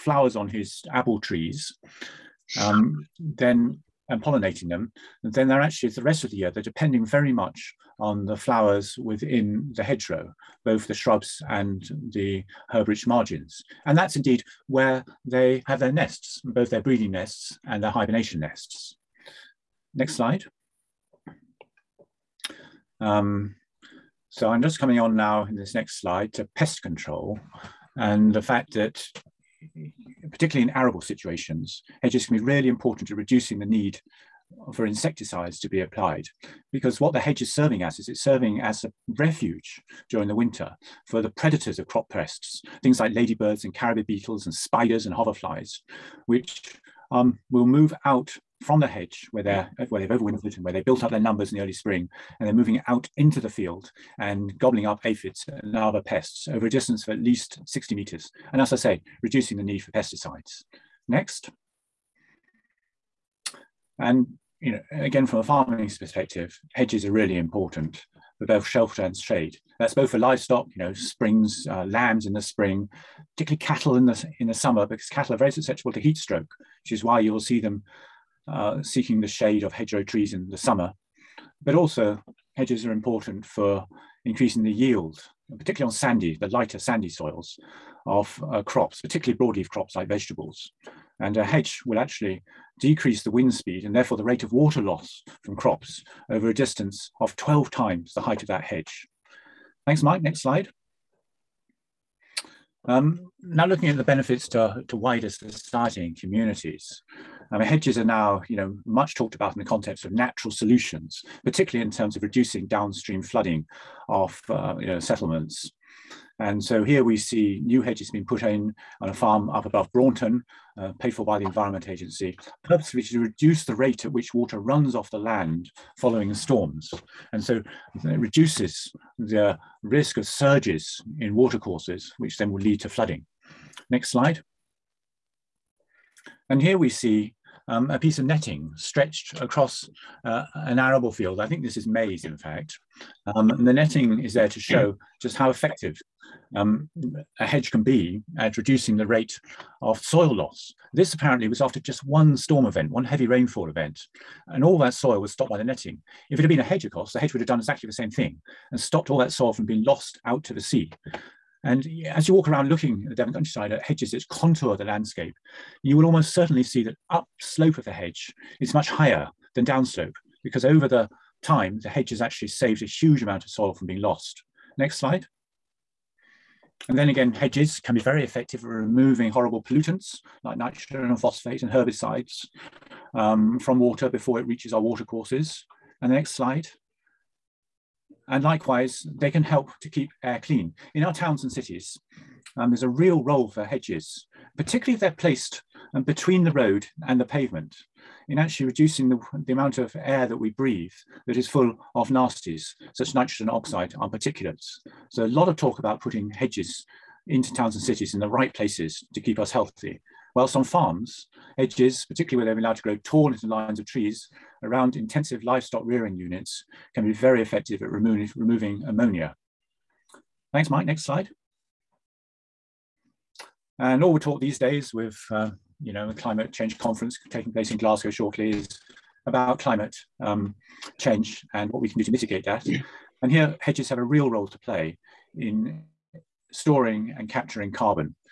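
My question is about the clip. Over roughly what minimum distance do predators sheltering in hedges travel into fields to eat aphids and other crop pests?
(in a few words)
60 meters.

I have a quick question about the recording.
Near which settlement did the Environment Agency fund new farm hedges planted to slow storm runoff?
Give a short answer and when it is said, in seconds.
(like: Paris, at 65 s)
Braunton, at 119 s.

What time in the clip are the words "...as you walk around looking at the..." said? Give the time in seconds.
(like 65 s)
162 s.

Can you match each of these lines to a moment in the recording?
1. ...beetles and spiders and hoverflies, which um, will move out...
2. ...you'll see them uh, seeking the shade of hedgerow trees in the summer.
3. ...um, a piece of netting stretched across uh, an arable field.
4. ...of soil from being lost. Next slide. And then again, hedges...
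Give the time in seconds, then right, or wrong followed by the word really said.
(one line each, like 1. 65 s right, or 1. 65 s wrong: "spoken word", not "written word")
1. 44 s right
2. 77 s right
3. 137 s right
4. 173 s right.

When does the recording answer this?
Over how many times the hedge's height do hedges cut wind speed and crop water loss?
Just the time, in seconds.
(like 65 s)
97 s.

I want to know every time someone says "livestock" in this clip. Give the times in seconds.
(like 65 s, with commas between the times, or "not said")
70 s, 215 s.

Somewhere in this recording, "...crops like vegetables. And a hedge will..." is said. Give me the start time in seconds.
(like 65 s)
89 s.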